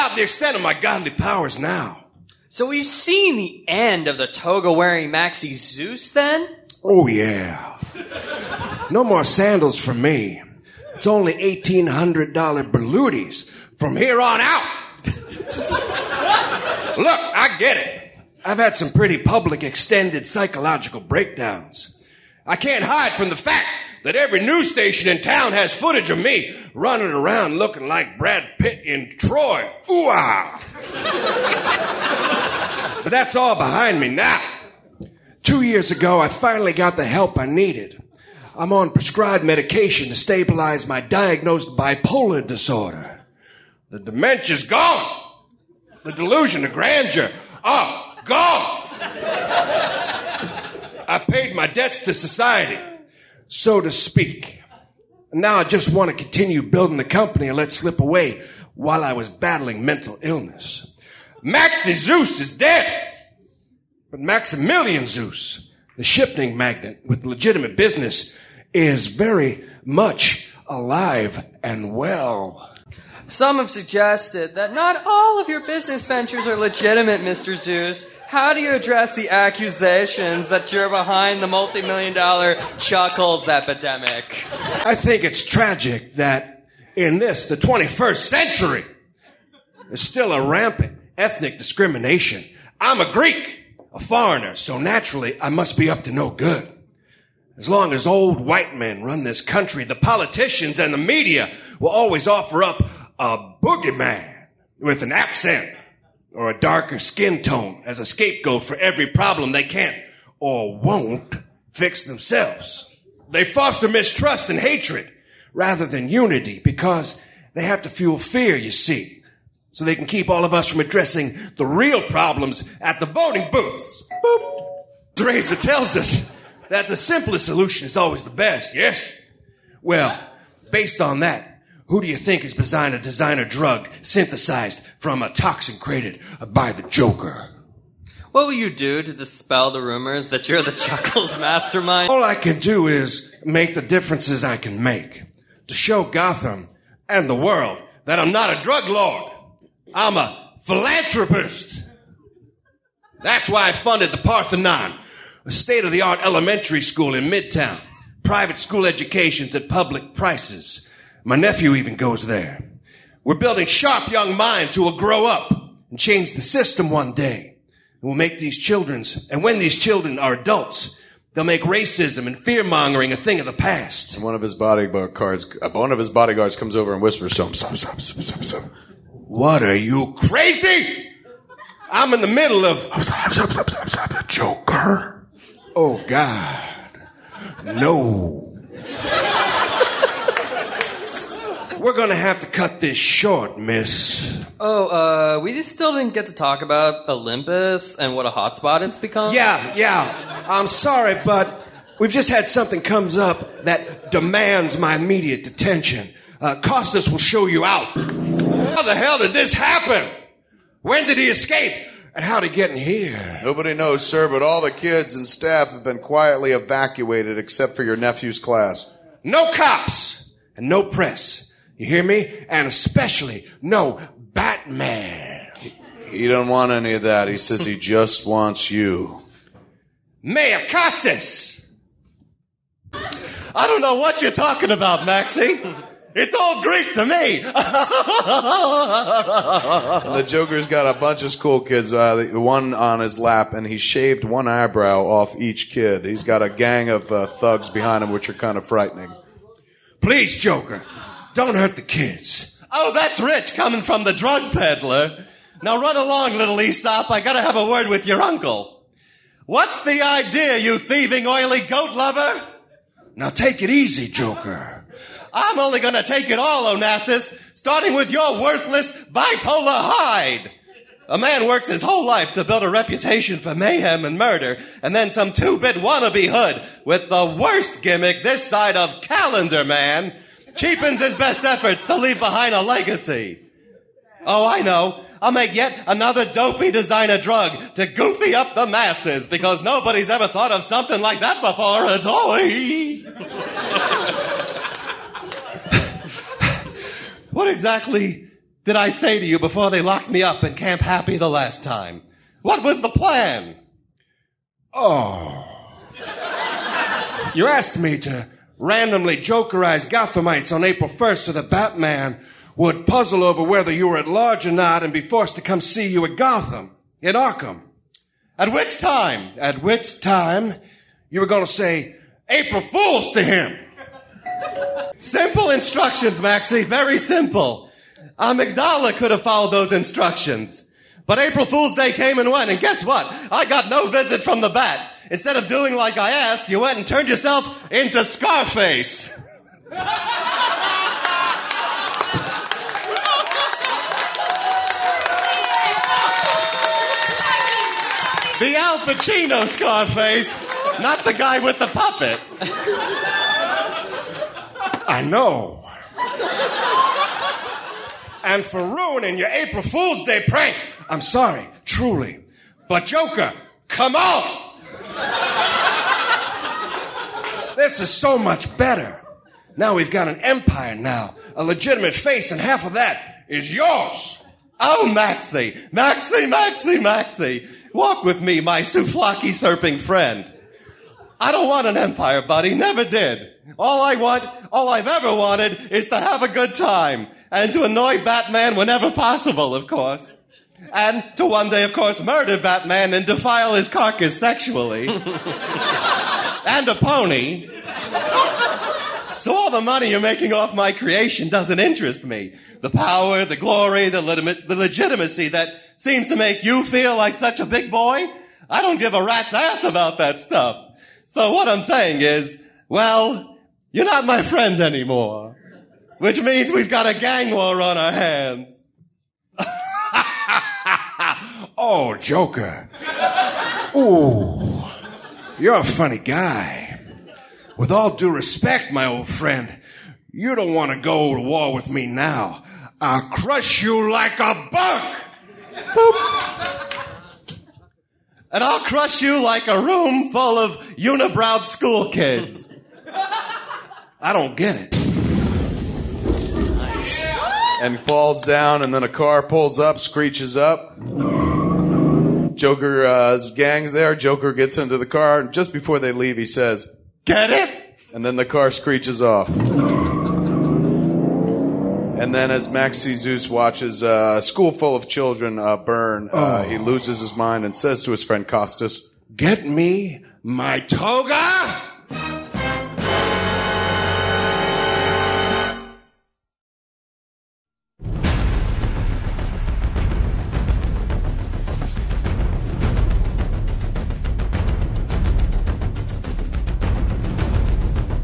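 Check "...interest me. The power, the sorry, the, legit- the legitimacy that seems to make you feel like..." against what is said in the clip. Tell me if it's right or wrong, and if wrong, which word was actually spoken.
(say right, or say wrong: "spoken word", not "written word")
wrong: "glory", not "sorry".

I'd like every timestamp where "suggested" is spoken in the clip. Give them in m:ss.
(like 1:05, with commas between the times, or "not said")
1:13.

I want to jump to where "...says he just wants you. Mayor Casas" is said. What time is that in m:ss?
3:47.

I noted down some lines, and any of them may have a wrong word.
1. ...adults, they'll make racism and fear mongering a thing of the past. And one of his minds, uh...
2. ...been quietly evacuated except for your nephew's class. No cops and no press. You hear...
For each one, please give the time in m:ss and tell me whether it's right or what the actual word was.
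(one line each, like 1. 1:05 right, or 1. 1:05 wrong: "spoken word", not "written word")
1. 2:50 wrong: "bodyguards", not "minds"
2. 3:35 right.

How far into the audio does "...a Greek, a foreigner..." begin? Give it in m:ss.
1:32.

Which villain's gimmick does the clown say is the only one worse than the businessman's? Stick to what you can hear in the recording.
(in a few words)
Calendar Man.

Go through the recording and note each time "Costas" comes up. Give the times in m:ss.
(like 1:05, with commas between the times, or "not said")
3:26, 7:48.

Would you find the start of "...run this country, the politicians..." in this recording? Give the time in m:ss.
1:39.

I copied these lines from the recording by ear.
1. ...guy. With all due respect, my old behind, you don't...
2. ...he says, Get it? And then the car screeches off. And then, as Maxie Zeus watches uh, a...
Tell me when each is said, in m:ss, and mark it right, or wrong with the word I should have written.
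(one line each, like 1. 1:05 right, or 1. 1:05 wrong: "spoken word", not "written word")
1. 7:05 wrong: "friend", not "behind"
2. 7:36 right.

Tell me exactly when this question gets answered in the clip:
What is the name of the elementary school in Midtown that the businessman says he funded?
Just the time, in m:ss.
2:34.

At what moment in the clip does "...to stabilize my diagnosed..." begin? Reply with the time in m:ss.
0:40.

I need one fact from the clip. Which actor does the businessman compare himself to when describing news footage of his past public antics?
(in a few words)
Brad Pitt.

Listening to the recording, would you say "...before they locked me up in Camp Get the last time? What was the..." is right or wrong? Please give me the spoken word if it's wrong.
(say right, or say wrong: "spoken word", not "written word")
wrong: "Happy", not "Get".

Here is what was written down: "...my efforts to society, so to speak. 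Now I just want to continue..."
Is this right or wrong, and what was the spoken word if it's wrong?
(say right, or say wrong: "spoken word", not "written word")
wrong: "debts", not "efforts".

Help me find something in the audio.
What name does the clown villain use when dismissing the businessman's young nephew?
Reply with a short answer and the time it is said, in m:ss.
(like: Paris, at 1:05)
Aesop, at 4:16.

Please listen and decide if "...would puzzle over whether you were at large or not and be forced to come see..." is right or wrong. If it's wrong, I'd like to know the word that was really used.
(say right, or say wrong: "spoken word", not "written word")
right.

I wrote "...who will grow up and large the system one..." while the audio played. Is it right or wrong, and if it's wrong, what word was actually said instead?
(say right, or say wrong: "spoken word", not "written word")
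wrong: "change", not "large".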